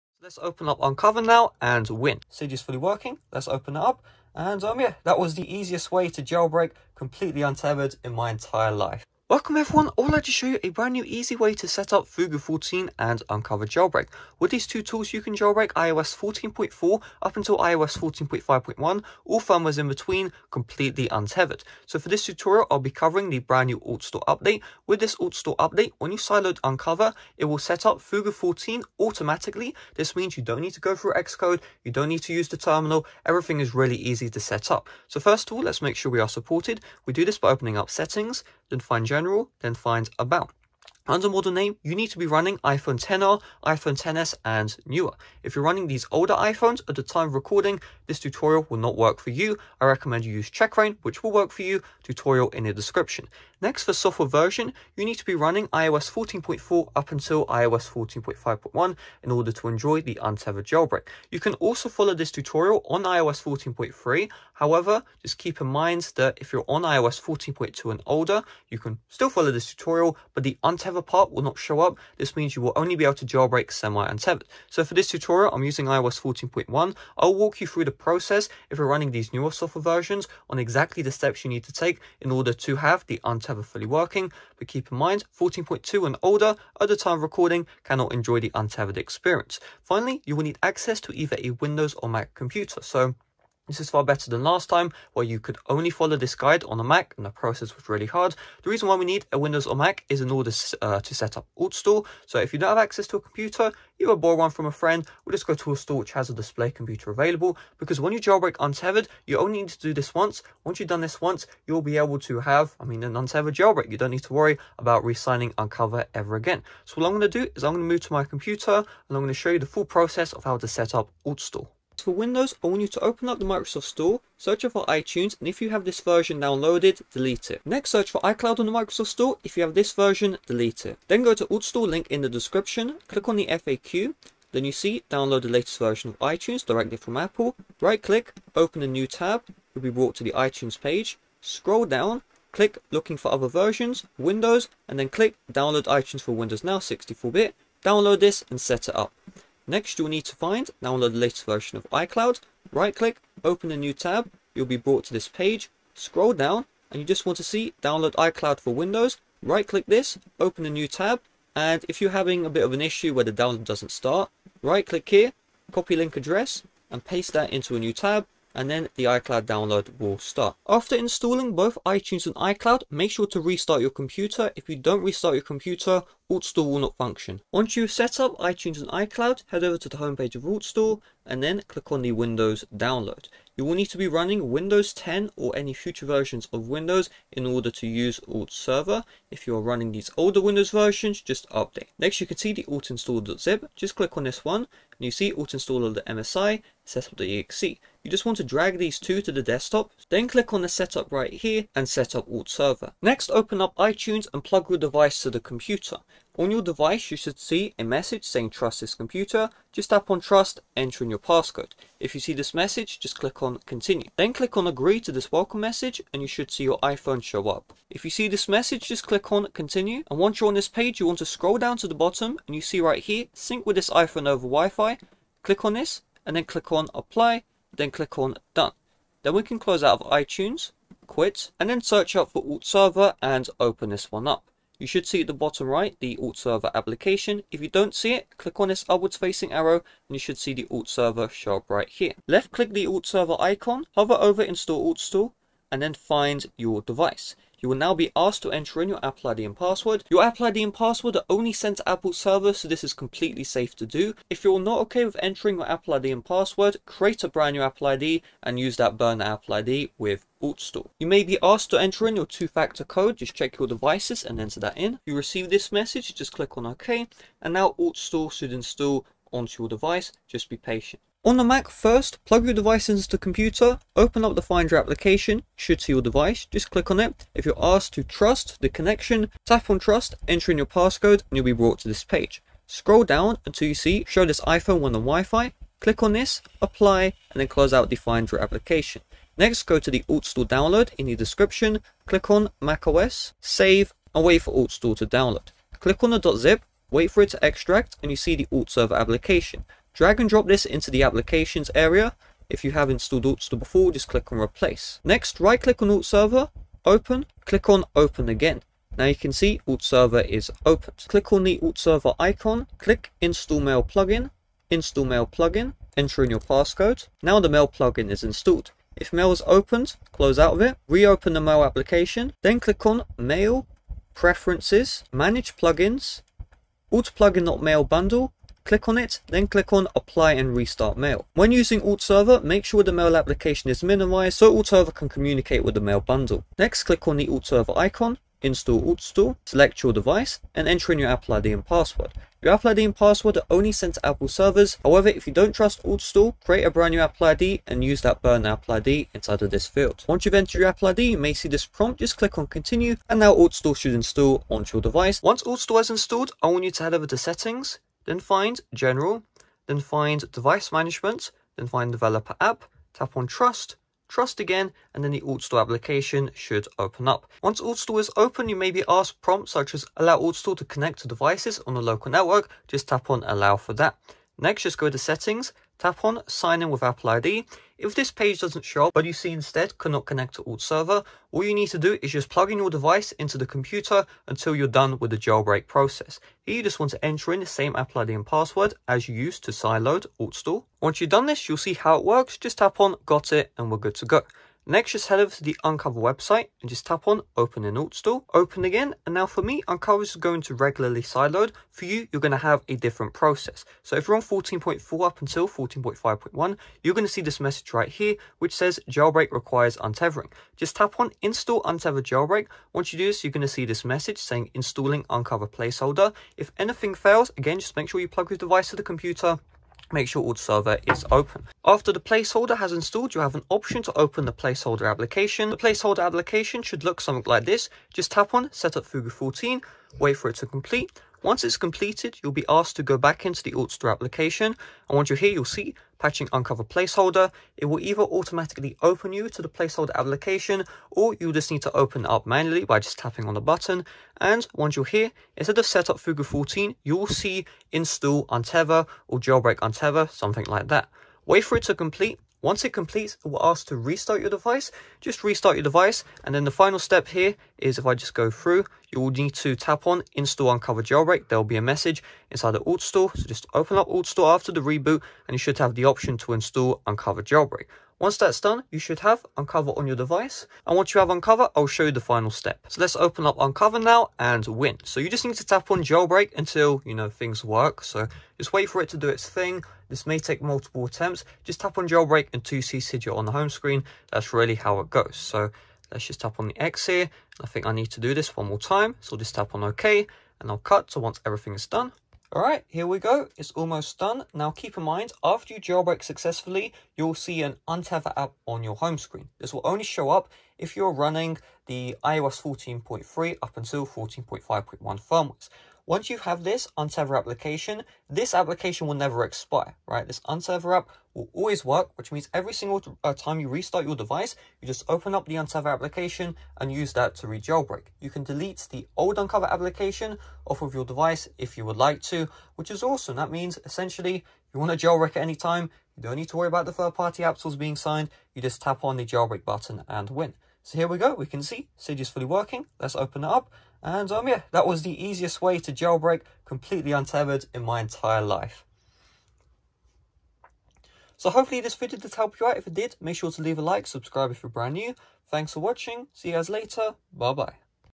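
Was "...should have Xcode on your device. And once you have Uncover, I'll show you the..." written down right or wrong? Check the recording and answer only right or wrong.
wrong.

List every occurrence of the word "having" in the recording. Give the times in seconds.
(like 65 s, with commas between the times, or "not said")
162 s.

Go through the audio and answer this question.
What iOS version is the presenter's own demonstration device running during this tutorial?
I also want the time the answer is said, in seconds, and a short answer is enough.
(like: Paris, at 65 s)
iOS 14.1, at 75 s.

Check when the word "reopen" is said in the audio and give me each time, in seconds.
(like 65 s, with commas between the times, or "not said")
320 s.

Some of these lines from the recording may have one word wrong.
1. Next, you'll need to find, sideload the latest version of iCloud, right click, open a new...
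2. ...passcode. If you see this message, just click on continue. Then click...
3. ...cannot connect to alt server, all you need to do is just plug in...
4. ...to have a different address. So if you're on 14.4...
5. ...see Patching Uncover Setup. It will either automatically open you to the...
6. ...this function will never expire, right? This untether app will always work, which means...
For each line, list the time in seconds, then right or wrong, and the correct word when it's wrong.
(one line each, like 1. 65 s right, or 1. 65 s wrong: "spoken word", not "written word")
1. 149 s wrong: "download", not "sideload"
2. 211 s right
3. 379 s right
4. 402 s wrong: "process", not "address"
5. 435 s wrong: "Placeholder", not "Setup"
6. 508 s wrong: "application", not "function".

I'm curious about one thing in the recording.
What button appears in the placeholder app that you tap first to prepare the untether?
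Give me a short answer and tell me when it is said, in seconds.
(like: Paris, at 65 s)
Set up Fugu 14, at 428 s.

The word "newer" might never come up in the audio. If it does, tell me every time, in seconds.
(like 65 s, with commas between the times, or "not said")
44 s, 79 s.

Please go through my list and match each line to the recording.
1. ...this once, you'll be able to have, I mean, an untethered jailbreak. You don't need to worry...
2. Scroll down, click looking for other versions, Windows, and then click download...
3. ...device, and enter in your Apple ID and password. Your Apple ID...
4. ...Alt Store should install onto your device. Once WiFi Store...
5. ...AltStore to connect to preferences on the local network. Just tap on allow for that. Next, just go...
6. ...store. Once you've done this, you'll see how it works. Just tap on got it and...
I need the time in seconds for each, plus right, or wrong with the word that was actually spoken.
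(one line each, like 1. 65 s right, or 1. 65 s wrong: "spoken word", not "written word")
1. 110 s right
2. 141 s right
3. 339 s right
4. 353 s wrong: "Alt", not "WiFi"
5. 370 s wrong: "devices", not "preferences"
6. 390 s right.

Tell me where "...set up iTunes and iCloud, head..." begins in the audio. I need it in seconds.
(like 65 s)
177 s.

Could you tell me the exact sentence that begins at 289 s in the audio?
Next go to the AltStore download in the description, click on macOS, save and wait for AltStore to download.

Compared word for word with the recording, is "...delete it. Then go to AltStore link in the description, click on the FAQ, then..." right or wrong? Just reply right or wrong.
right.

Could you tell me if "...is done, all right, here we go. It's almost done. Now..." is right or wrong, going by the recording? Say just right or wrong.
right.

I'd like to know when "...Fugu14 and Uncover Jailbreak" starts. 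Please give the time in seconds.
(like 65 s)
12 s.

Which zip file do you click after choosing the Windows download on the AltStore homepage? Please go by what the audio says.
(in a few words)
alt install.zip.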